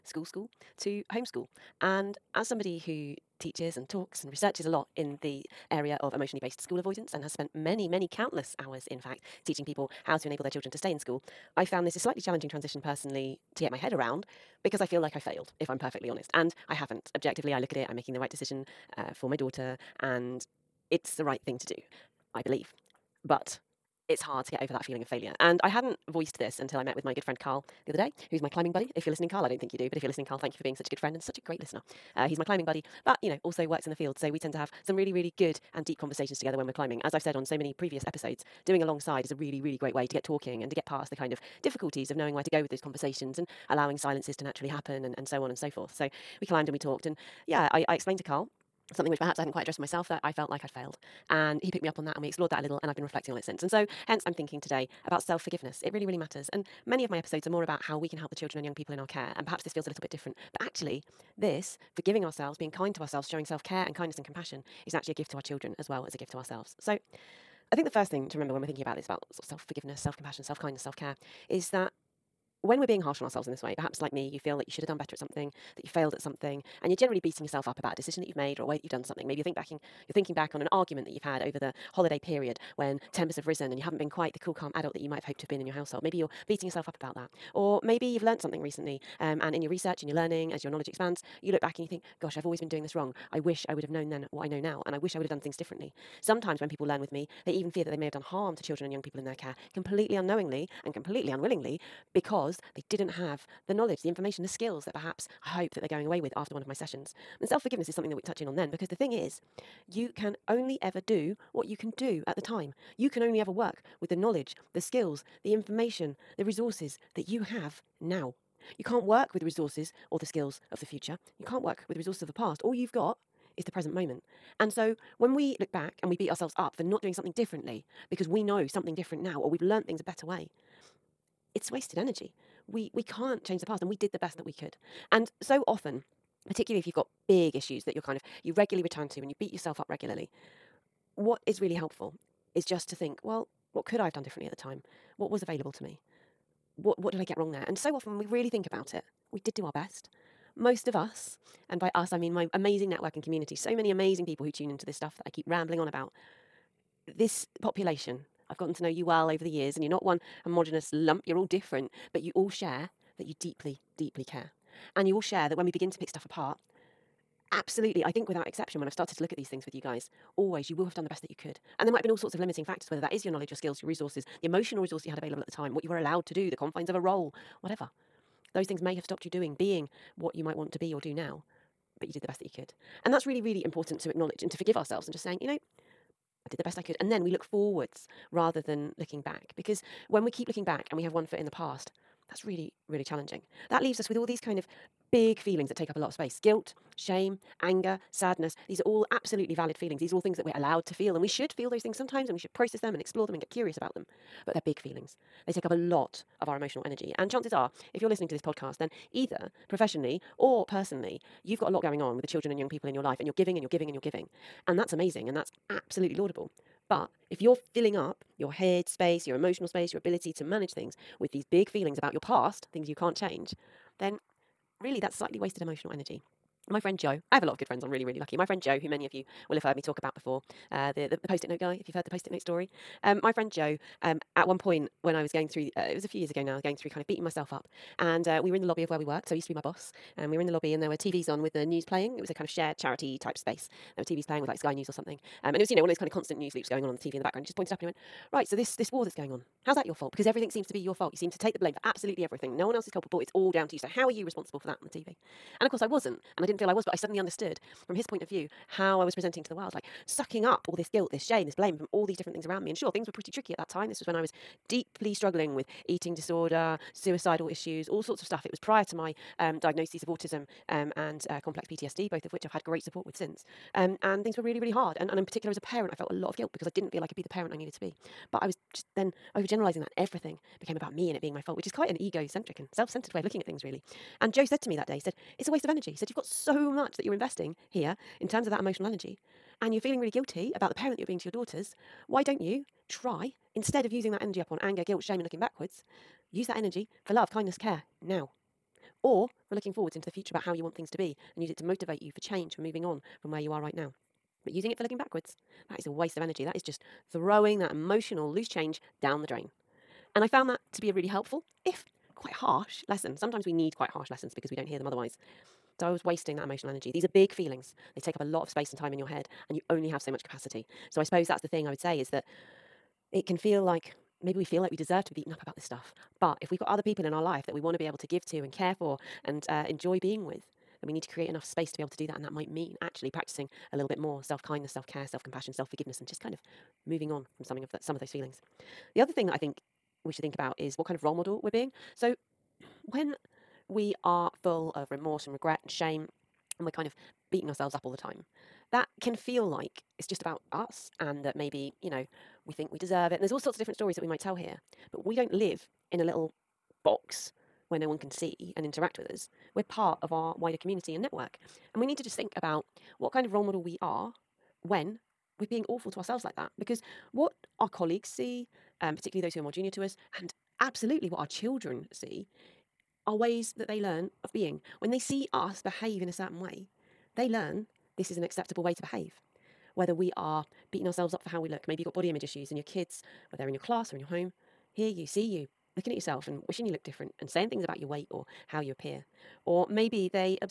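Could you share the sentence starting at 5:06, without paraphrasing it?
That is just throwing that emotional loose change down the drain.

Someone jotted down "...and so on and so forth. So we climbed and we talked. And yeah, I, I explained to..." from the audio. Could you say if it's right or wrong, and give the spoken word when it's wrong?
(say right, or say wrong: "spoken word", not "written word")
right.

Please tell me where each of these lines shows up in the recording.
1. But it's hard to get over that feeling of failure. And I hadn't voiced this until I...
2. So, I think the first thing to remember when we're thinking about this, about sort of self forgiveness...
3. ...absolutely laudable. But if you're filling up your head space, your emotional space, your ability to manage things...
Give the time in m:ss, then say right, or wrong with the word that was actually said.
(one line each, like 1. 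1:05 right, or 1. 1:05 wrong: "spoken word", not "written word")
1. 0:23 right
2. 1:06 right
3. 3:35 right.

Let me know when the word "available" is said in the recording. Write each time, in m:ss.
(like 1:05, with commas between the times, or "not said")
2:25, 2:55.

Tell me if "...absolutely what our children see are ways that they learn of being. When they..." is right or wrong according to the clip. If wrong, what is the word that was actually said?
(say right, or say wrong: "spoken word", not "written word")
right.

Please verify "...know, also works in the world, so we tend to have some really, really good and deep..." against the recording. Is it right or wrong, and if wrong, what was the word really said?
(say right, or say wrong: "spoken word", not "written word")
wrong: "field", not "world".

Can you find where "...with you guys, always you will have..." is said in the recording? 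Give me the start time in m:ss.
2:49.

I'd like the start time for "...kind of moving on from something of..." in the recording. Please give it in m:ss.
5:36.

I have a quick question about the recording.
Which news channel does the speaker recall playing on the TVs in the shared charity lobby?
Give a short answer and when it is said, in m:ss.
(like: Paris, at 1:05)
Sky News, at 4:04.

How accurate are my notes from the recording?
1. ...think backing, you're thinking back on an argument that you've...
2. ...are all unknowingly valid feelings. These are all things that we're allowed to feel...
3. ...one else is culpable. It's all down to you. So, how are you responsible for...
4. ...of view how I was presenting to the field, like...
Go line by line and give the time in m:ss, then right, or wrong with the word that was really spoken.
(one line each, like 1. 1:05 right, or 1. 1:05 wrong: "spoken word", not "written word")
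1. 1:19 right
2. 3:18 wrong: "absolutely", not "unknowingly"
3. 4:12 right
4. 4:18 wrong: "world", not "field".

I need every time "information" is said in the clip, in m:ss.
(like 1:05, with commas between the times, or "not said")
1:44, 1:55.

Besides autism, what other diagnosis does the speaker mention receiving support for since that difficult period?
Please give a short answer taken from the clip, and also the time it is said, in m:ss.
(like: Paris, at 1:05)
Complex PTSD, at 4:31.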